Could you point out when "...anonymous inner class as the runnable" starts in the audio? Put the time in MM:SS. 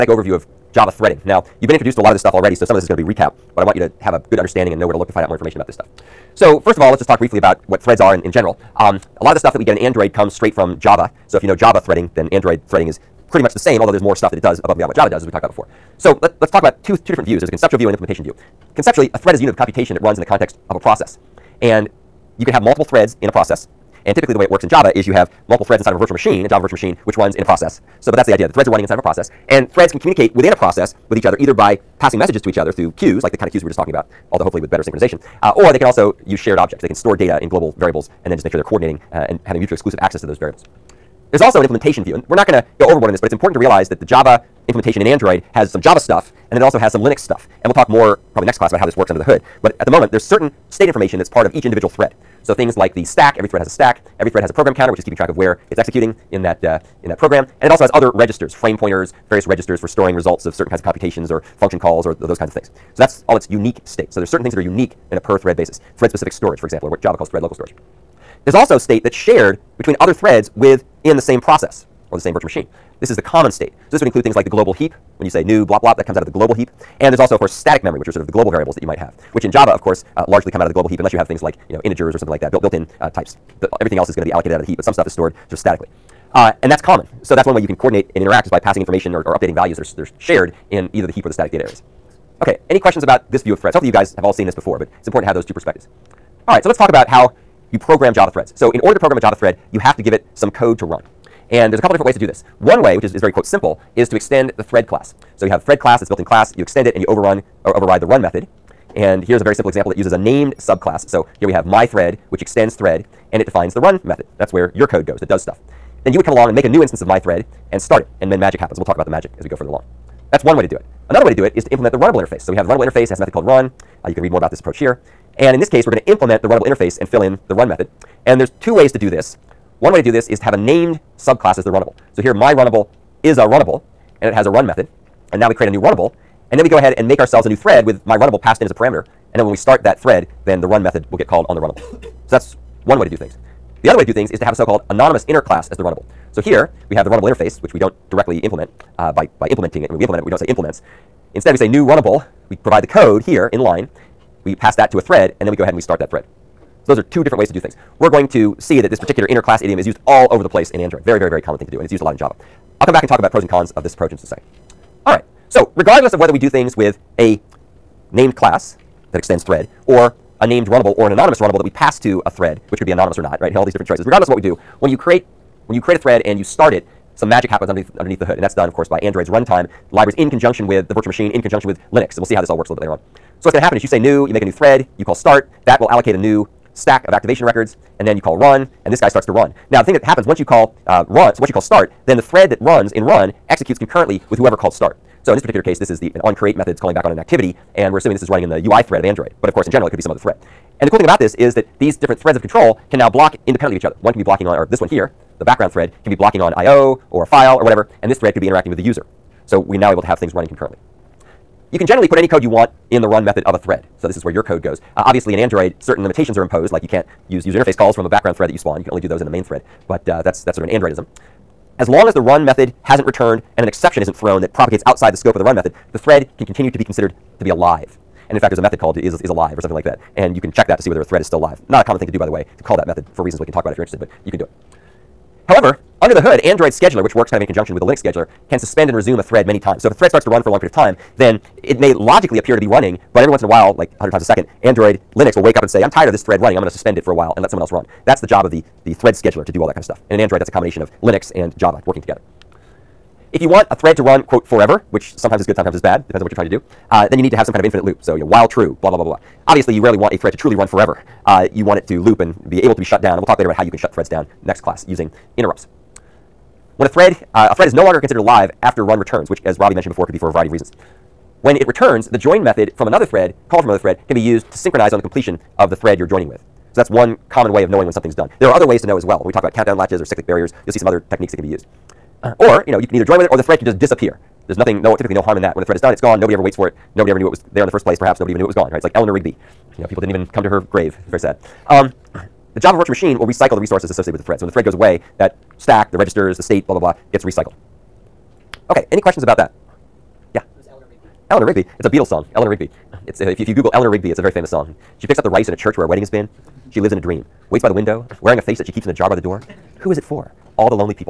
02:24.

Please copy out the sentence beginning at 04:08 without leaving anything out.
That's the job of the, the thread scheduler to do all that kind of stuff.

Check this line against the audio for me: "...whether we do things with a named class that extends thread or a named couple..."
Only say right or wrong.
wrong.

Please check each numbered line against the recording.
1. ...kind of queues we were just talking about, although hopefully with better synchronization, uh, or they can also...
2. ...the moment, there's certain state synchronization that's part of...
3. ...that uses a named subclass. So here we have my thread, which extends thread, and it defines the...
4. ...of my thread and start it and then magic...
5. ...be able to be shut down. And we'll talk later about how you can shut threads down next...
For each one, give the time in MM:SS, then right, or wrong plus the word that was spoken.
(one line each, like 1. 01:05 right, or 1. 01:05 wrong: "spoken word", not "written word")
1. 00:33 right
2. 00:49 wrong: "information", not "synchronization"
3. 01:49 right
4. 01:56 right
5. 04:22 right.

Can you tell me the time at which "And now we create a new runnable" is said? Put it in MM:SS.
02:15.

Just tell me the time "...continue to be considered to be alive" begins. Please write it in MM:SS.
03:46.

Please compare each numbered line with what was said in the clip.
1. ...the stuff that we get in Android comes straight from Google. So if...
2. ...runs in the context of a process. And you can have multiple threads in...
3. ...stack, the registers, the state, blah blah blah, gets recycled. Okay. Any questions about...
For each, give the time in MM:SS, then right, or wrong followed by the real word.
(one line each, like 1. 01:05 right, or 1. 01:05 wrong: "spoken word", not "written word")
1. 00:09 wrong: "Java", not "Google"
2. 00:20 right
3. 04:55 right.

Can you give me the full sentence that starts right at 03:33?
So this is where your code goes.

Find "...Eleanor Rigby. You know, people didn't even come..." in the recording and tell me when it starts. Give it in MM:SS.
04:48.